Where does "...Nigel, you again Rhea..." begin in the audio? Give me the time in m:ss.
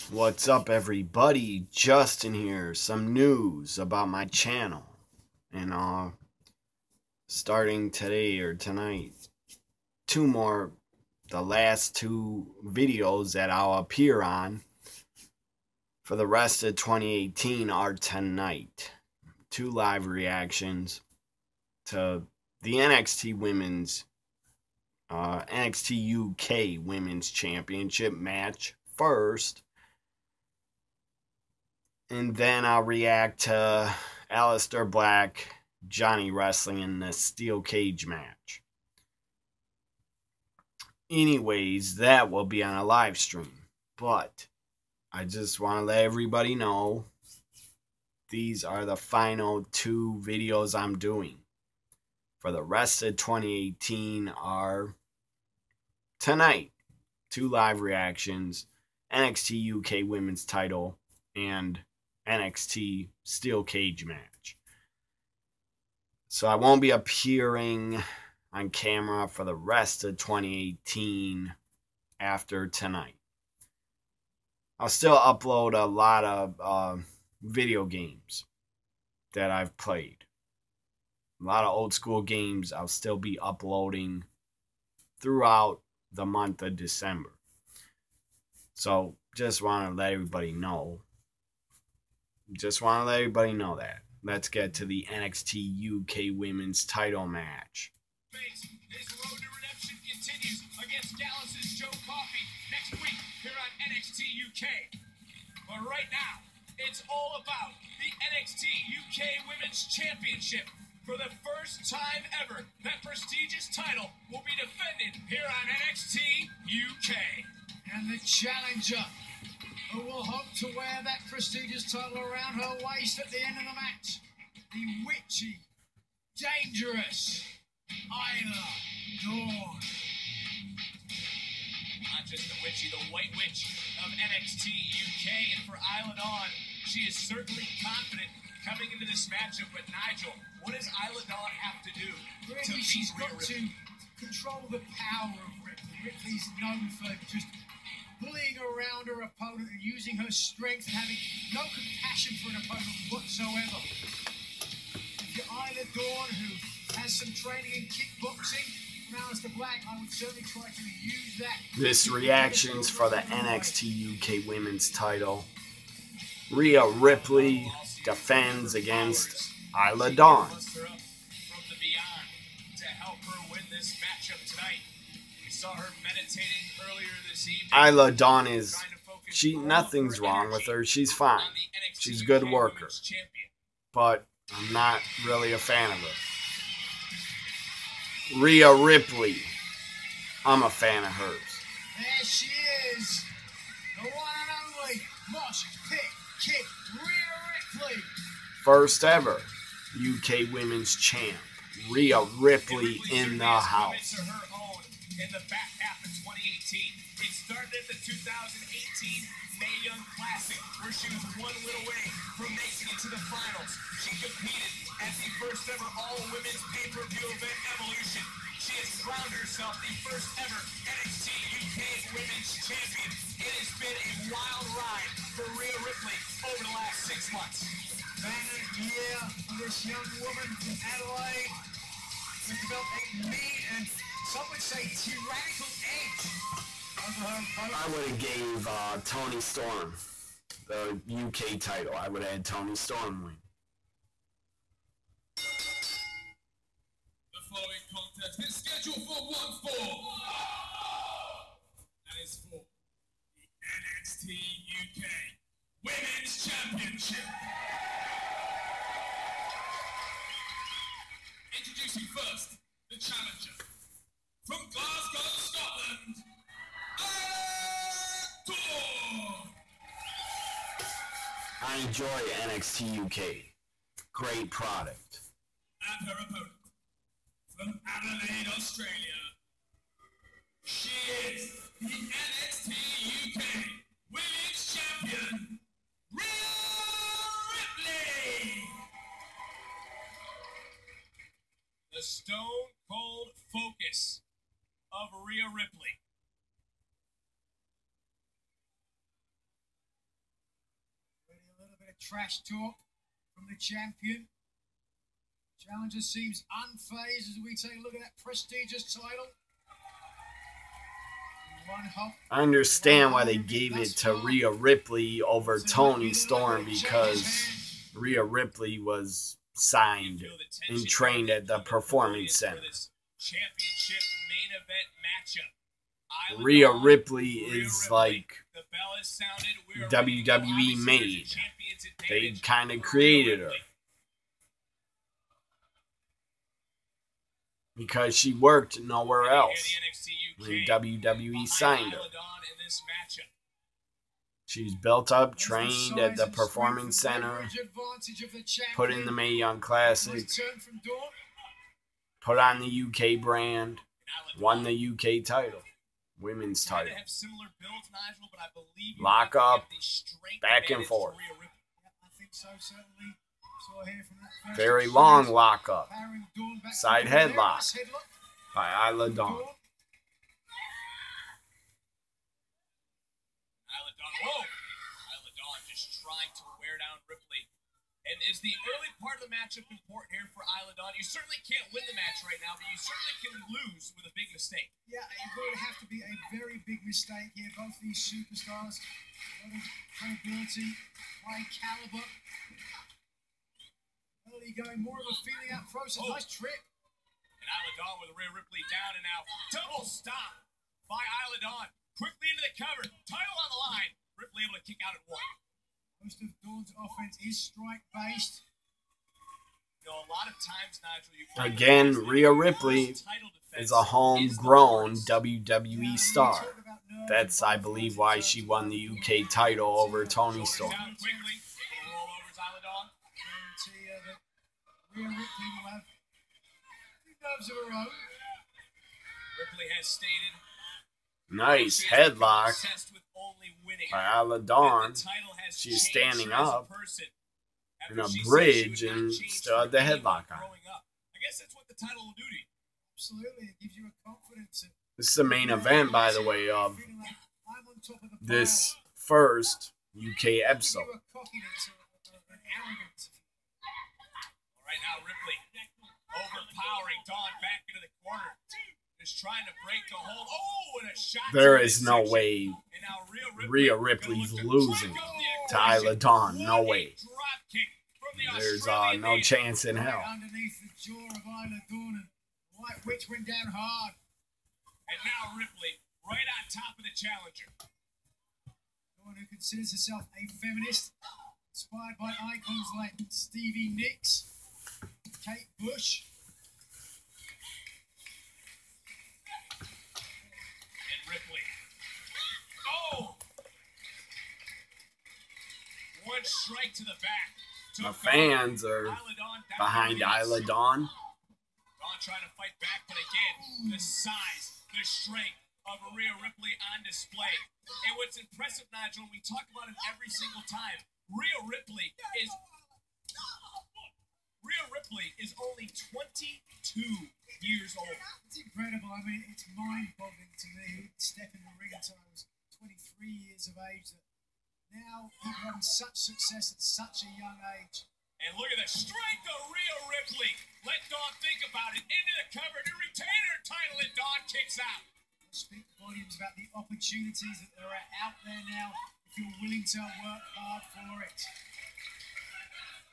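6:50.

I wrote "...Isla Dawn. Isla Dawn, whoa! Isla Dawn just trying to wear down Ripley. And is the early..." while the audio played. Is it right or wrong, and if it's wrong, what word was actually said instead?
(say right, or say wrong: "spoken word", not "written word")
right.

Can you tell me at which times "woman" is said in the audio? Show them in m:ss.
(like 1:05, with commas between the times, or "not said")
3:50.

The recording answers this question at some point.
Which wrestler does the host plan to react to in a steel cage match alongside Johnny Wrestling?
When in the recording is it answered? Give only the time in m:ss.
0:34.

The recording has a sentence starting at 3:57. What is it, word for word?
I would have gave uh, Toni Storm the UK title.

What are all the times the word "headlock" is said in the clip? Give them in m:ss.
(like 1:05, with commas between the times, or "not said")
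6:07, 7:11, 7:19.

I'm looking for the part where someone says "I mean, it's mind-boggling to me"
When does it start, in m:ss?
8:38.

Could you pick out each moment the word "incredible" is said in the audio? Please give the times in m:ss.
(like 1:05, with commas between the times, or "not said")
8:38.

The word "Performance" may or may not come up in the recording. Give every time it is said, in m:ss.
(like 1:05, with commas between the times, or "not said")
5:21, 5:46.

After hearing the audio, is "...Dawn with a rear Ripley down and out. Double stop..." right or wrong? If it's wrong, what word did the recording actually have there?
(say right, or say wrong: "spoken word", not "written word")
right.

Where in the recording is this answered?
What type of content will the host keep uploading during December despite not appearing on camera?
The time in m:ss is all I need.
1:17.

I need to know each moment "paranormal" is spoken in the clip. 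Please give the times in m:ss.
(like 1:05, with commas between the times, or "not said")
not said.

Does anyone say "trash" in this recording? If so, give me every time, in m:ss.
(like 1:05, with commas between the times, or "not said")
5:01.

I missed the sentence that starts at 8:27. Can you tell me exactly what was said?
And what's impressive, Nigel, we talk about it every single time.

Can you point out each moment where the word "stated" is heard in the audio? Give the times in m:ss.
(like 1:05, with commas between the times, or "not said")
7:09.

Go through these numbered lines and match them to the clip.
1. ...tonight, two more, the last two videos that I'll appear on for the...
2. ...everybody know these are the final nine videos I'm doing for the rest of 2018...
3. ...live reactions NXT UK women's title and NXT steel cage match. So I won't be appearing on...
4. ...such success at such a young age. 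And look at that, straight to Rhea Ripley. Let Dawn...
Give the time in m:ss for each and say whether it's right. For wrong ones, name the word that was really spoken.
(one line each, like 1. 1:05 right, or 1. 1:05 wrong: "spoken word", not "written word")
1. 0:08 right
2. 0:46 wrong: "two", not "nine"
3. 0:57 right
4. 8:45 right.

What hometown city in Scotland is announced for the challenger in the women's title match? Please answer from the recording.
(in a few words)
Glasgow.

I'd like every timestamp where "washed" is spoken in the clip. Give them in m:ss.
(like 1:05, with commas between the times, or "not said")
not said.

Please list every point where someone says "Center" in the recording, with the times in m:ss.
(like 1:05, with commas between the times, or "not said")
5:22, 5:46.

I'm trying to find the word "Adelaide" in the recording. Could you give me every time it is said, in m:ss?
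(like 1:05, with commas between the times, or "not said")
3:50, 4:37.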